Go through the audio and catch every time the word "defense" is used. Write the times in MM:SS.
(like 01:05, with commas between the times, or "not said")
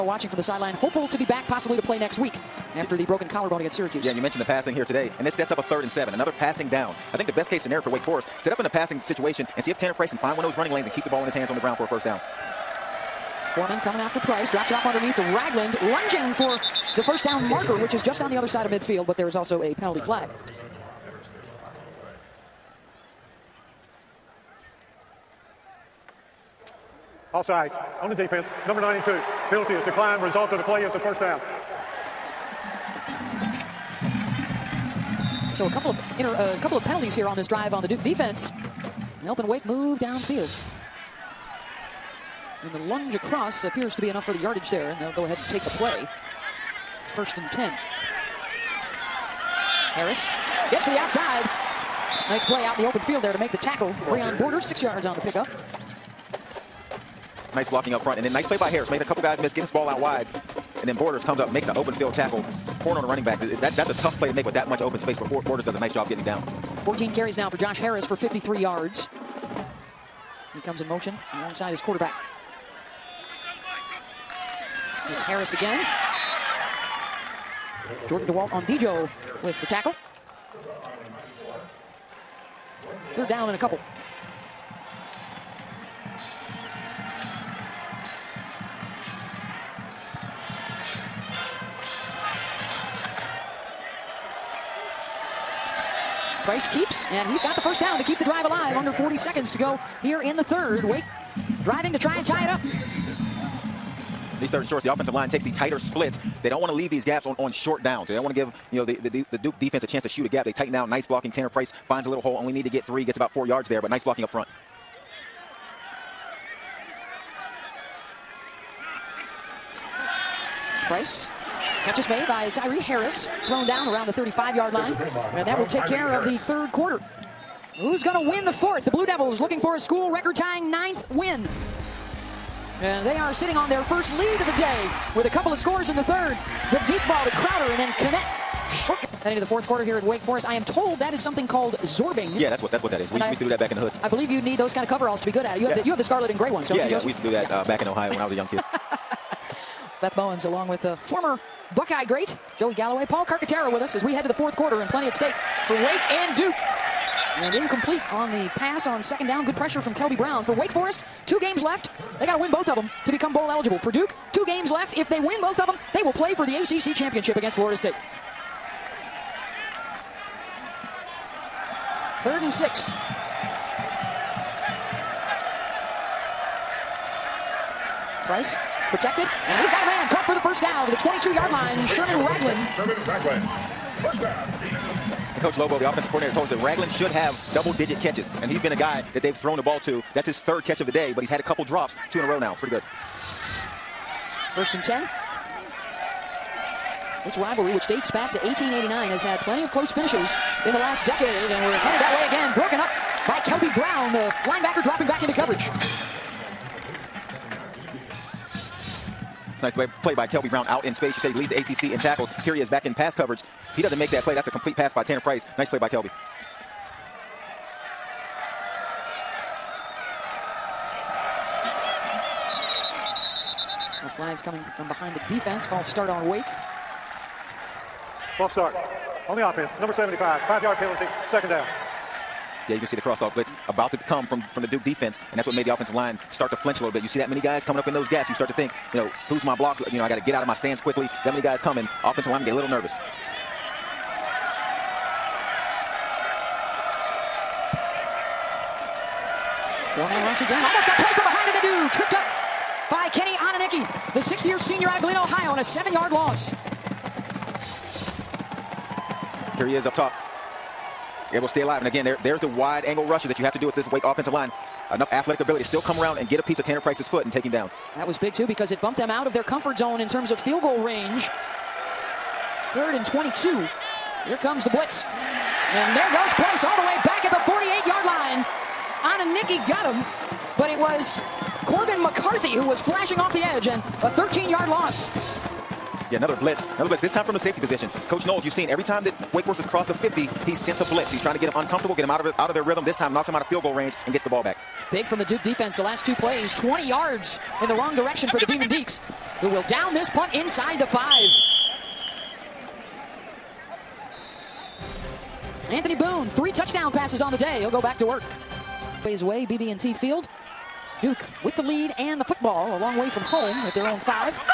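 00:28, 00:38, 01:49, 03:45, 03:54, 04:55.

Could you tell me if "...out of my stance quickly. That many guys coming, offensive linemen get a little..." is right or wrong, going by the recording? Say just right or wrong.
right.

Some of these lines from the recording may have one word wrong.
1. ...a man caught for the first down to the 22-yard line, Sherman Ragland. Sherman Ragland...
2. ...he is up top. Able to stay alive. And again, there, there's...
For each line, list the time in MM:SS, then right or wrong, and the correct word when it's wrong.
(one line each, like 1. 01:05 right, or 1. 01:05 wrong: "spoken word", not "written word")
1. 02:59 right
2. 04:19 right.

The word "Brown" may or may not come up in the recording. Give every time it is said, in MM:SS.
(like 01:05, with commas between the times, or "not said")
02:40, 03:23, 03:30.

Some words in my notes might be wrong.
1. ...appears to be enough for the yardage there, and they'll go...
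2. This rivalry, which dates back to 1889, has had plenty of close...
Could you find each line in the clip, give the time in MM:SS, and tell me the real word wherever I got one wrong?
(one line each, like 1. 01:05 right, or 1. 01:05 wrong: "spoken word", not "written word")
1. 00:43 right
2. 03:17 right.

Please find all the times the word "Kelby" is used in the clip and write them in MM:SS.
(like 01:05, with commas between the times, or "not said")
02:39, 03:23, 03:30, 03:35.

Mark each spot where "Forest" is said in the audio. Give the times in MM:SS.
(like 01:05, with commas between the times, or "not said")
00:08, 02:20, 02:40, 04:49.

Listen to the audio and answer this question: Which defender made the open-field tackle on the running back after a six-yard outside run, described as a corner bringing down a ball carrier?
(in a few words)
Breon Borders.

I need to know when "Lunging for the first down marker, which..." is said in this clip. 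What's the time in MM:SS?
00:15.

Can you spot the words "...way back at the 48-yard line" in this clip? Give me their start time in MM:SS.
04:36.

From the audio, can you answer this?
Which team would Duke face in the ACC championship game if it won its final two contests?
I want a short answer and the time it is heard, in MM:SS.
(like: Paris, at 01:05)
Florida State, at 02:47.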